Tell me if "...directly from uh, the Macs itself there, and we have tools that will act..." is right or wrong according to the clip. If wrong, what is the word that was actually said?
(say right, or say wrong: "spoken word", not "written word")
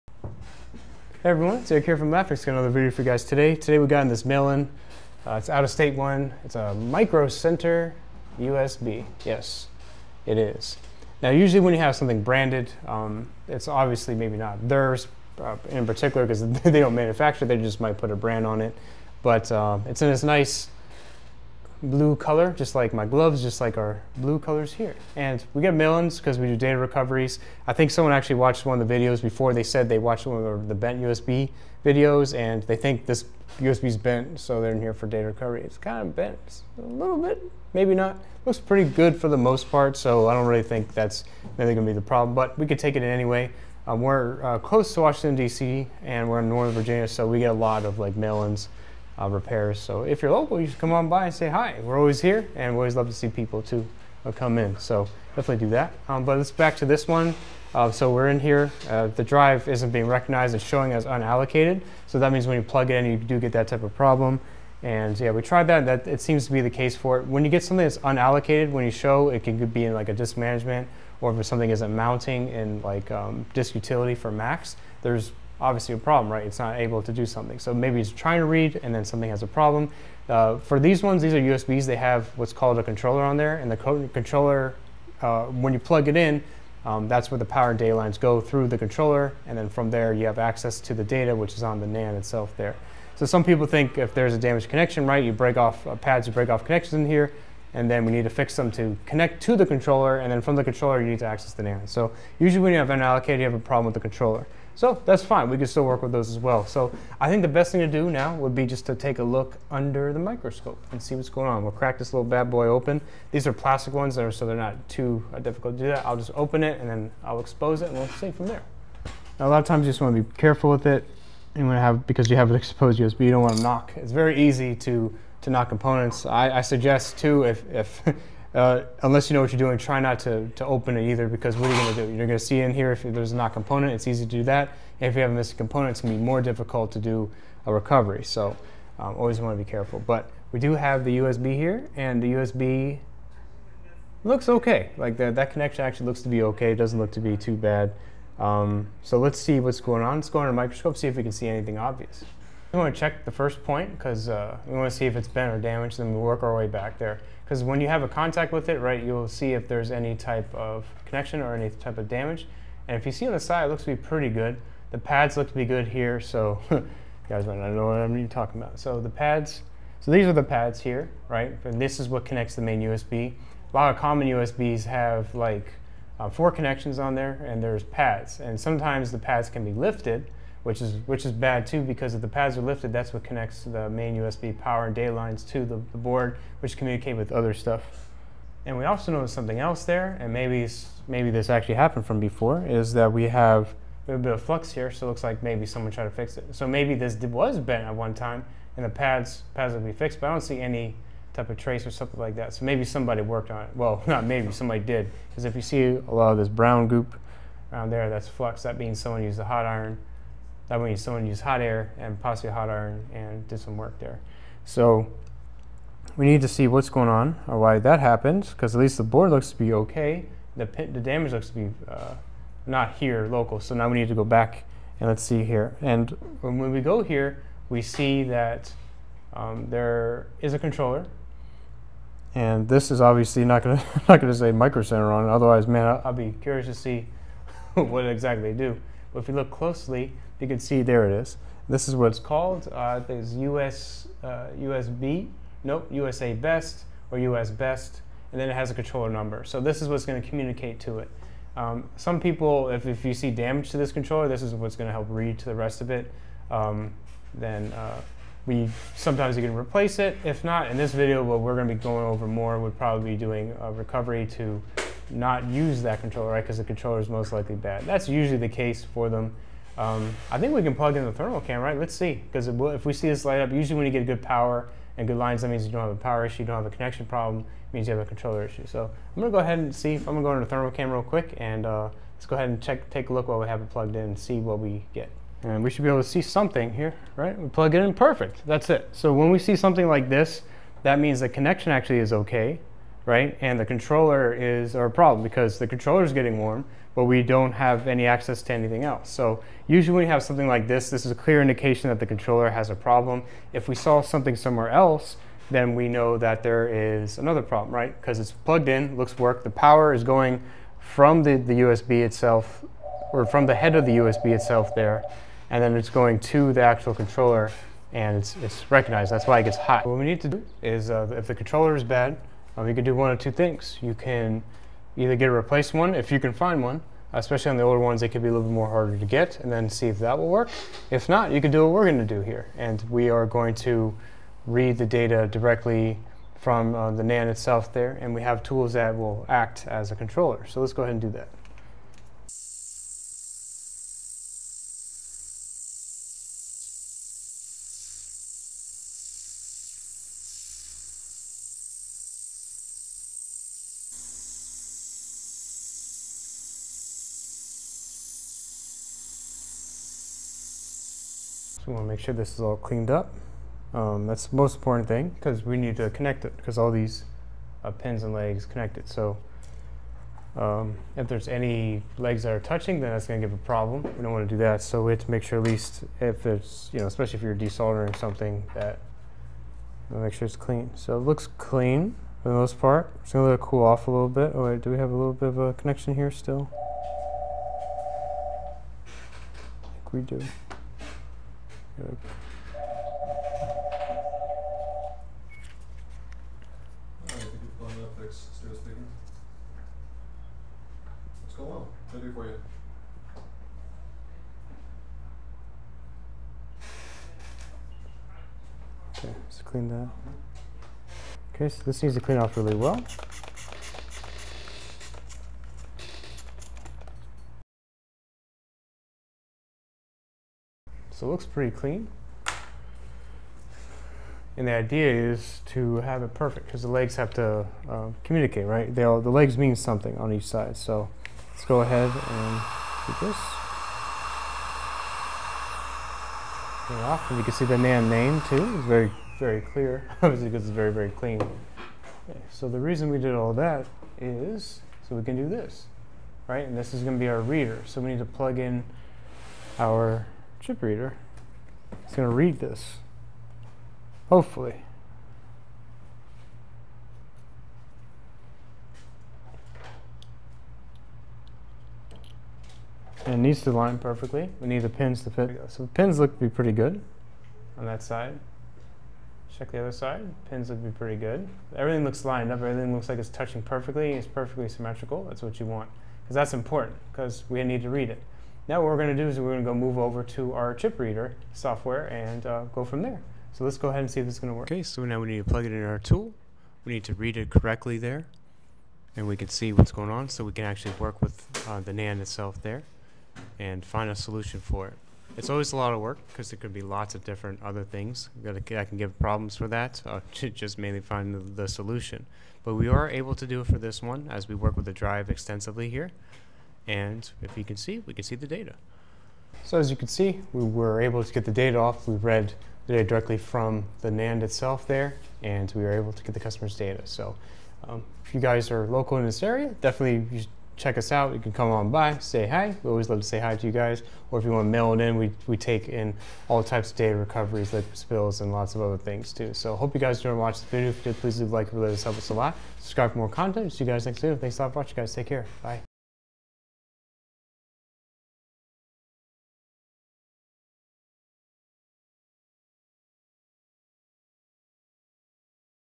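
wrong: "NAND", not "Macs".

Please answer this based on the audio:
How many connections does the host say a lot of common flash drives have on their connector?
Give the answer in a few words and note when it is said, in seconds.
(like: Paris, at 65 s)
4, at 176 s.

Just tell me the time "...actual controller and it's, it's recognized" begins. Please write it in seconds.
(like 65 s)
316 s.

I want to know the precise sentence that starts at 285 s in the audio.
And we should be able to see something here, right?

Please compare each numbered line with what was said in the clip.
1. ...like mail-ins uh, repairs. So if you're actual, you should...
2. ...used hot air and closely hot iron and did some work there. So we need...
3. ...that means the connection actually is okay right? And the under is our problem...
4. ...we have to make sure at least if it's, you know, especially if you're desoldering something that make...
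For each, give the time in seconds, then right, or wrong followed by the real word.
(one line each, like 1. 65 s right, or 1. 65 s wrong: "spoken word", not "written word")
1. 47 s wrong: "local", not "actual"
2. 211 s wrong: "possibly", not "closely"
3. 290 s wrong: "controller", not "under"
4. 374 s right.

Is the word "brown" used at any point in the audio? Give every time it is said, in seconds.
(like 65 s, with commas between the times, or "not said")
206 s.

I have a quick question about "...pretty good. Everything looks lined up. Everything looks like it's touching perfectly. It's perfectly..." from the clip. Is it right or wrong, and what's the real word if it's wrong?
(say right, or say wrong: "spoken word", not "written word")
right.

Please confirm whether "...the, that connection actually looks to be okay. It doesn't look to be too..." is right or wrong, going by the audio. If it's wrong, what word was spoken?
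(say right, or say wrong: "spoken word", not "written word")
right.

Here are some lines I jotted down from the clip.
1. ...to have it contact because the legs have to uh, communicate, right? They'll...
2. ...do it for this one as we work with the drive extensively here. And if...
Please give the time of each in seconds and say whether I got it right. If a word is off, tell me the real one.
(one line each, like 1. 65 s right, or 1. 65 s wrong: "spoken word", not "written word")
1. 425 s wrong: "perfect", not "contact"
2. 503 s right.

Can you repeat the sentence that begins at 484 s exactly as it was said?
Okay, so now we need to plug it in our tool.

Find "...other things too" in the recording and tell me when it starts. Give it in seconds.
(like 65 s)
528 s.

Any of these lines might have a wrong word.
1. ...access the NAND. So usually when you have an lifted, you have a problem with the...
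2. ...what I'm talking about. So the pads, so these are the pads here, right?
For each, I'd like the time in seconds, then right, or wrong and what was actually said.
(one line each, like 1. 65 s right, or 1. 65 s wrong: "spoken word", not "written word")
1. 101 s wrong: "allocated", not "lifted"
2. 167 s right.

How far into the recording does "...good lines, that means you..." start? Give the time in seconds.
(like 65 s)
275 s.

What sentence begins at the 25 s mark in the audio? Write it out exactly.
And we get millions because we do data recoveries.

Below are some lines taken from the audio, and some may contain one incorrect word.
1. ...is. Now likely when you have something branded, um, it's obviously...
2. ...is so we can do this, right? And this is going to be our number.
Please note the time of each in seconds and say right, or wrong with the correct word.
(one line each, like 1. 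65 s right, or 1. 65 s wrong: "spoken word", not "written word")
1. 10 s wrong: "usually", not "likely"
2. 443 s wrong: "reader", not "number".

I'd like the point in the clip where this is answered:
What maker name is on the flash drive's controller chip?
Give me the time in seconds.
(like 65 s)
245 s.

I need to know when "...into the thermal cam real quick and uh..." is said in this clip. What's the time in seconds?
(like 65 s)
280 s.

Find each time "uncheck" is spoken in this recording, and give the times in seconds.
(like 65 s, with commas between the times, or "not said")
not said.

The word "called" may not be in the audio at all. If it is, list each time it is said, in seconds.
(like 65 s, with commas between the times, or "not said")
82 s, 242 s.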